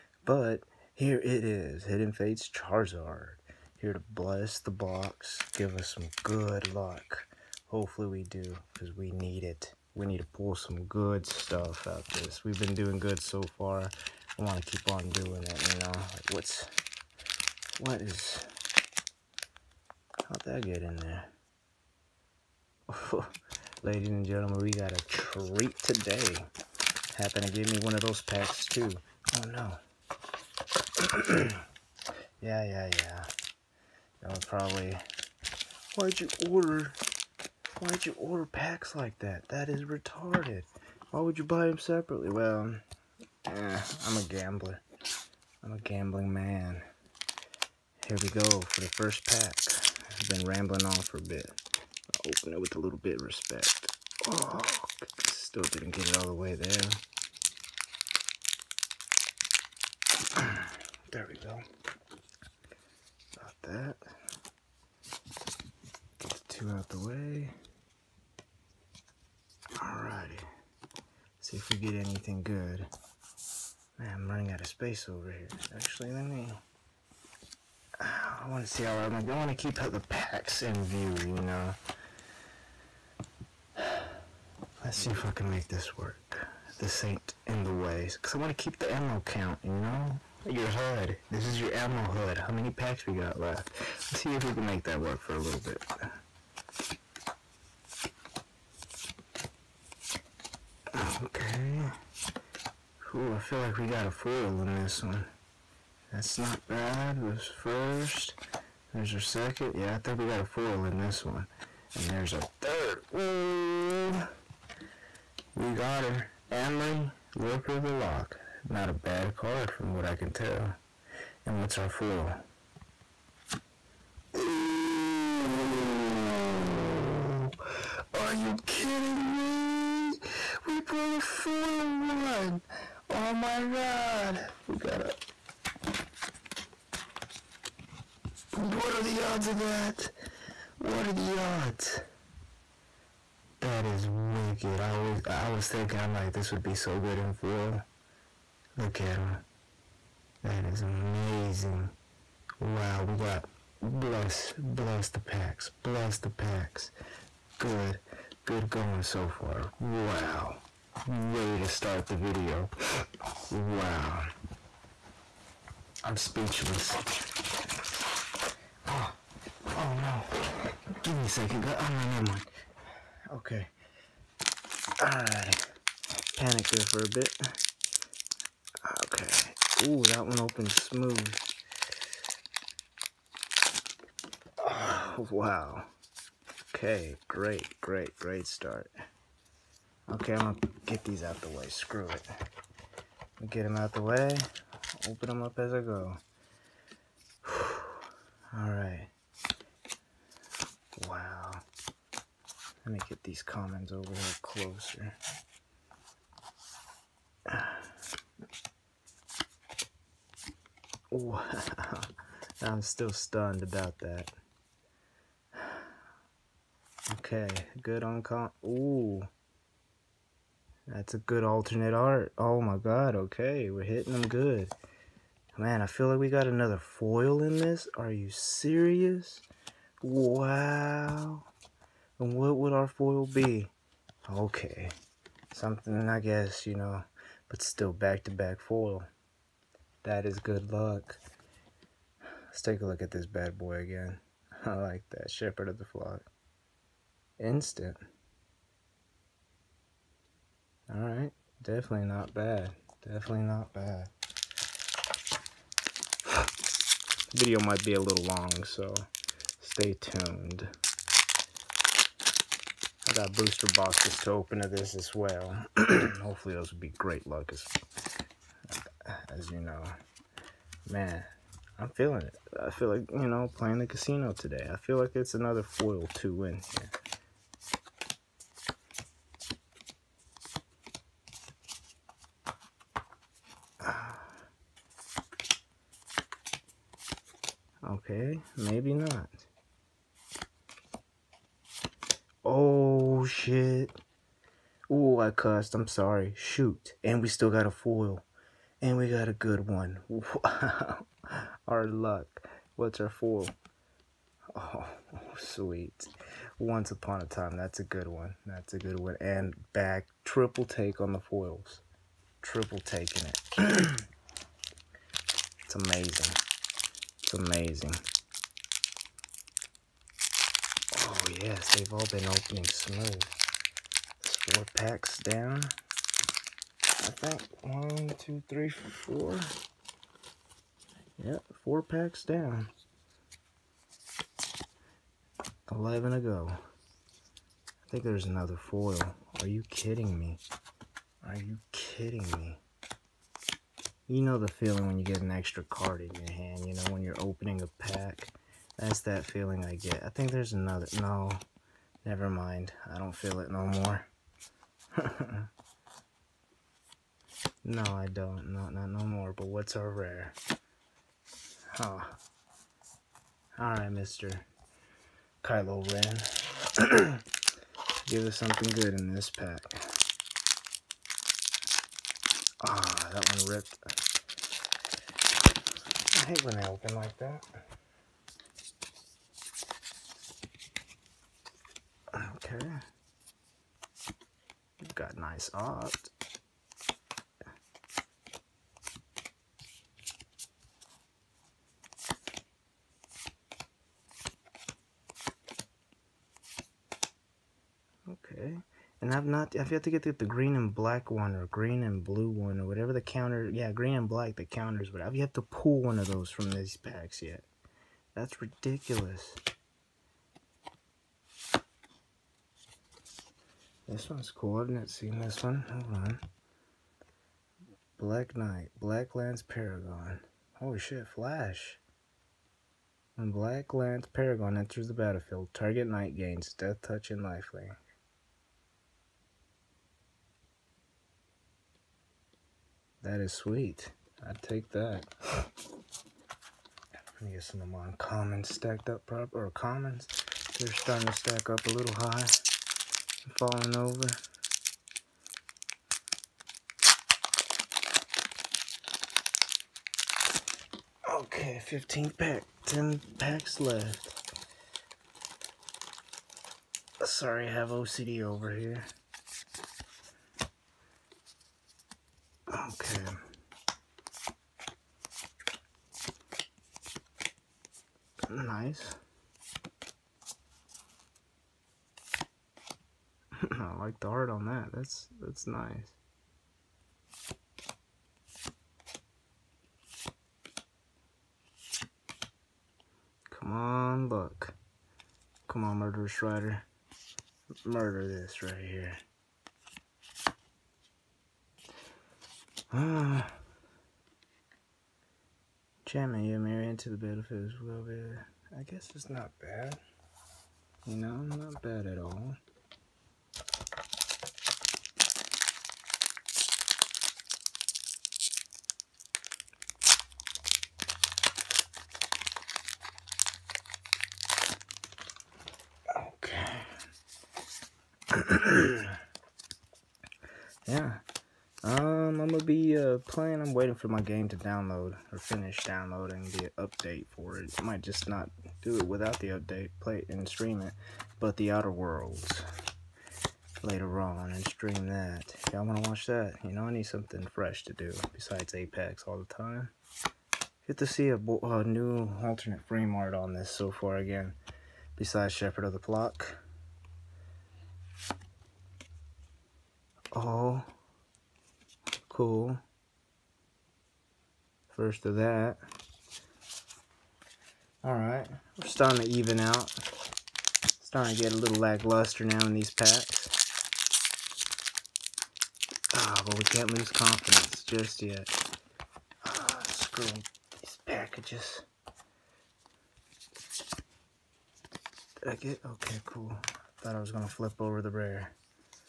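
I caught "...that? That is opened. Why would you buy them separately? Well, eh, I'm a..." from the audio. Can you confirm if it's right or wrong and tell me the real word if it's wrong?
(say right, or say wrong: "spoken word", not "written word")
wrong: "retarded", not "opened".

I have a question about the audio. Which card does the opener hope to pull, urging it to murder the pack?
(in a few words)
Murderous Rider.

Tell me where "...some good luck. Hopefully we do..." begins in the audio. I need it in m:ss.
0:05.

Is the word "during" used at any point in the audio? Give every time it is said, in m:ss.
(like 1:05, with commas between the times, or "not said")
not said.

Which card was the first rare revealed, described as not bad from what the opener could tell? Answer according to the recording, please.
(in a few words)
Emry, Lurker of the Loch.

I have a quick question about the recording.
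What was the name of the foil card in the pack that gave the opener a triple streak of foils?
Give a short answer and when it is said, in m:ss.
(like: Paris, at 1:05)
Once Upon a Time, at 5:06.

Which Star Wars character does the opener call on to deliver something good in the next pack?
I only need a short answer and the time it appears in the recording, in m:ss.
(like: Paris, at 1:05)
Kylo Ren, at 6:05.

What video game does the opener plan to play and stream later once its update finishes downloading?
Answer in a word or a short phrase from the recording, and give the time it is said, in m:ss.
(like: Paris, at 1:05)
The Outer Worlds, at 8:51.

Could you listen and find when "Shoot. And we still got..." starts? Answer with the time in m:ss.
4:56.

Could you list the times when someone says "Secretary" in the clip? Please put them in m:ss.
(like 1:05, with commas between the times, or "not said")
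not said.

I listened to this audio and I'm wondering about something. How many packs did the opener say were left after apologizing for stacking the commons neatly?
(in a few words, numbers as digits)
10.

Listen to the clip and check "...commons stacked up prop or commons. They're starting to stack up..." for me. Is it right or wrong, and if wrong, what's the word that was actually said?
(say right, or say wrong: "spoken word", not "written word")
right.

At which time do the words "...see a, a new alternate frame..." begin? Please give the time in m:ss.
9:00.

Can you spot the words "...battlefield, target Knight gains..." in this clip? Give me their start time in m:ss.
7:04.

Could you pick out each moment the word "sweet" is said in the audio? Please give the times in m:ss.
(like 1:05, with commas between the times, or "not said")
5:05, 7:13.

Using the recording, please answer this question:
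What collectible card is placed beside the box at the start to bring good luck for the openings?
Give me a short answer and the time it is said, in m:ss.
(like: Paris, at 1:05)
Hidden Fates Charizard, at 0:01.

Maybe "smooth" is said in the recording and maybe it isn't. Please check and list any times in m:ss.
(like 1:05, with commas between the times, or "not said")
3:00, 5:22.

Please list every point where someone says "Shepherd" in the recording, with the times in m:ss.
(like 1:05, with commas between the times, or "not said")
4:05, 9:05.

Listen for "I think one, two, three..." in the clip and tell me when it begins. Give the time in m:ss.
5:26.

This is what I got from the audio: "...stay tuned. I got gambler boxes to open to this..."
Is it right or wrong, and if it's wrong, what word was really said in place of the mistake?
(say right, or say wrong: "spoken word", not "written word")
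wrong: "booster", not "gambler".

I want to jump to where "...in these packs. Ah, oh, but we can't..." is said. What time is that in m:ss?
9:22.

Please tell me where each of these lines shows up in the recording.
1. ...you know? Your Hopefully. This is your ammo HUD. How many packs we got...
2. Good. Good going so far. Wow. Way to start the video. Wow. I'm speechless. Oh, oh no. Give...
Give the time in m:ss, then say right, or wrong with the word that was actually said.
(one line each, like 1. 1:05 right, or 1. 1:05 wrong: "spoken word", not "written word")
1. 1:29 wrong: "HUD", not "Hopefully"
2. 2:37 right.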